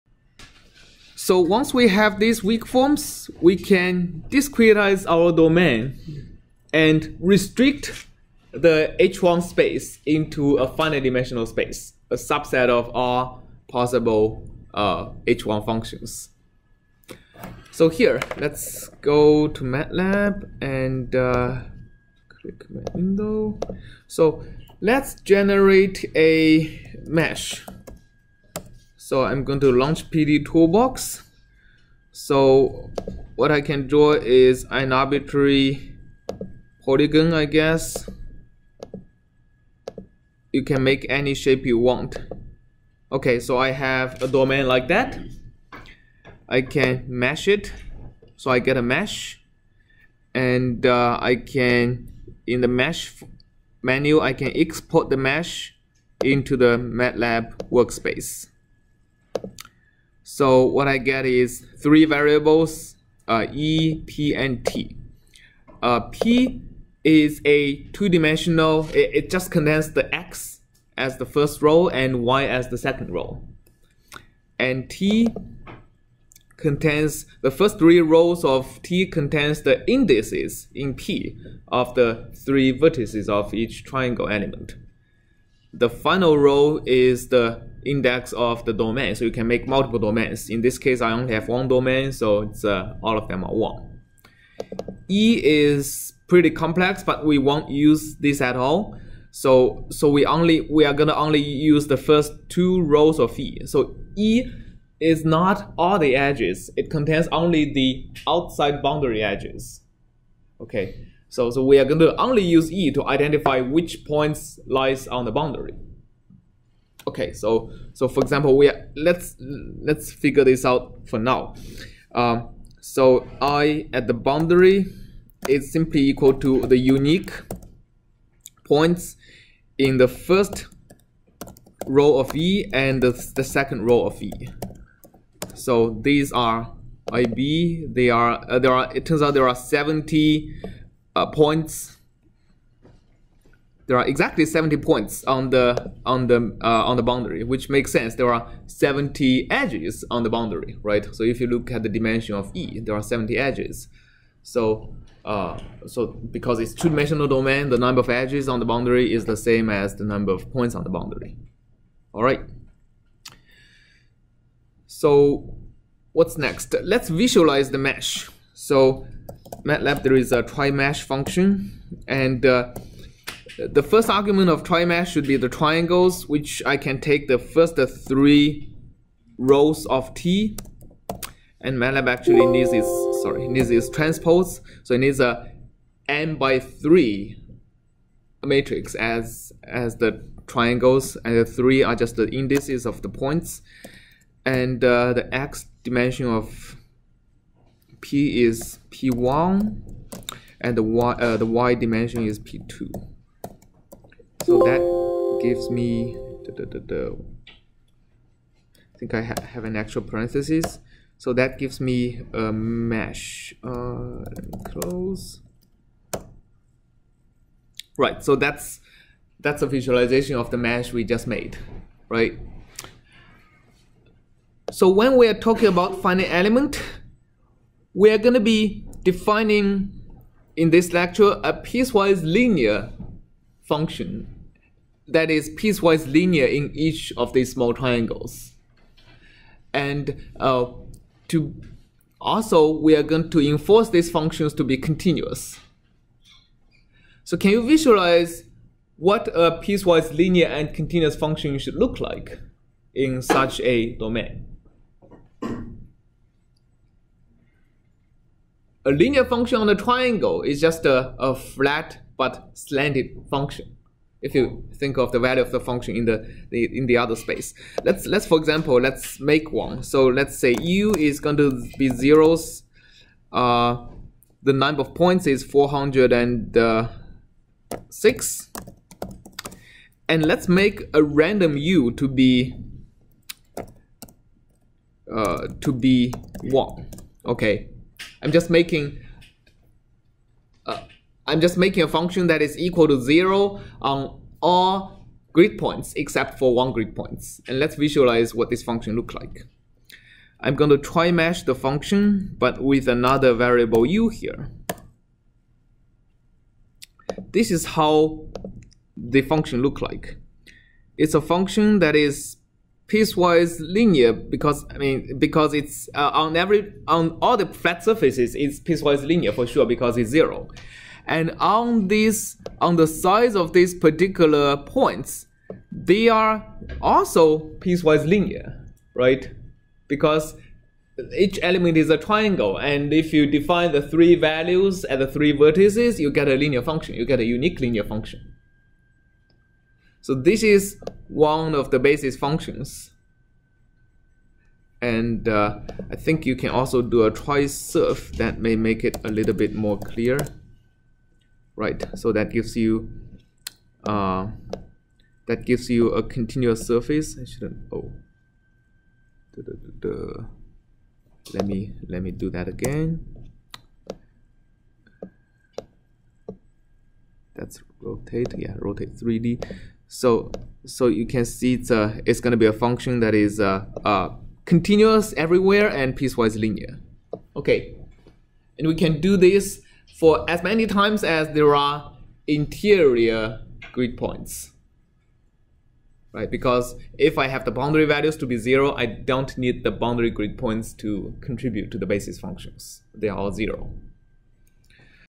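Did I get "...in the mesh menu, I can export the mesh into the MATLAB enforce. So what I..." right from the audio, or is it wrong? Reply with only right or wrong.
wrong.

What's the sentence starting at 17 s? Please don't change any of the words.
So here, let's go to MATLAB and uh, click my window.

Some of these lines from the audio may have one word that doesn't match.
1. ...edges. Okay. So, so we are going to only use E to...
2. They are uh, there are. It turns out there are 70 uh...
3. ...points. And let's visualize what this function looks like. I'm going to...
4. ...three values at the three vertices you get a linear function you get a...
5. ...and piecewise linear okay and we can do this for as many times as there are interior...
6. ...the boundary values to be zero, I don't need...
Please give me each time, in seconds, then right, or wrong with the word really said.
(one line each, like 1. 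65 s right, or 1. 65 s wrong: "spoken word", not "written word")
1. 109 s right
2. 137 s right
3. 296 s right
4. 333 s right
5. 375 s right
6. 387 s right.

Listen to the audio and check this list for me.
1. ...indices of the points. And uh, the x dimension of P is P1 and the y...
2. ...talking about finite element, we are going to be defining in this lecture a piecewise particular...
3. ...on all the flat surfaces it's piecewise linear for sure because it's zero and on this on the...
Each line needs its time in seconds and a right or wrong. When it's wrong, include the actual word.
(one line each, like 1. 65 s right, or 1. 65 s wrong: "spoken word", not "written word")
1. 192 s right
2. 225 s wrong: "linear", not "particular"
3. 316 s right.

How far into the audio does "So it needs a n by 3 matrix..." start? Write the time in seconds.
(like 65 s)
184 s.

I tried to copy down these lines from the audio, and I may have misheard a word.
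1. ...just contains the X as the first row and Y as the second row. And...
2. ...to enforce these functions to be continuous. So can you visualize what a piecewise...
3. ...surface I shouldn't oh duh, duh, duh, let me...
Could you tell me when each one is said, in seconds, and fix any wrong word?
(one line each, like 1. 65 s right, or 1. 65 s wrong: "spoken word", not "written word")
1. 69 s right
2. 243 s right
3. 356 s right.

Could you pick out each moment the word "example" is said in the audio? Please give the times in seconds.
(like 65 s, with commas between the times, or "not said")
118 s, 268 s.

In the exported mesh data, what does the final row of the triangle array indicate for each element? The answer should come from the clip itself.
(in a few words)
index of the domain.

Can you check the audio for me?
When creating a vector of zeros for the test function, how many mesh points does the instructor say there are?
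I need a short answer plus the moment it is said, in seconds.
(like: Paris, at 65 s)
406, at 275 s.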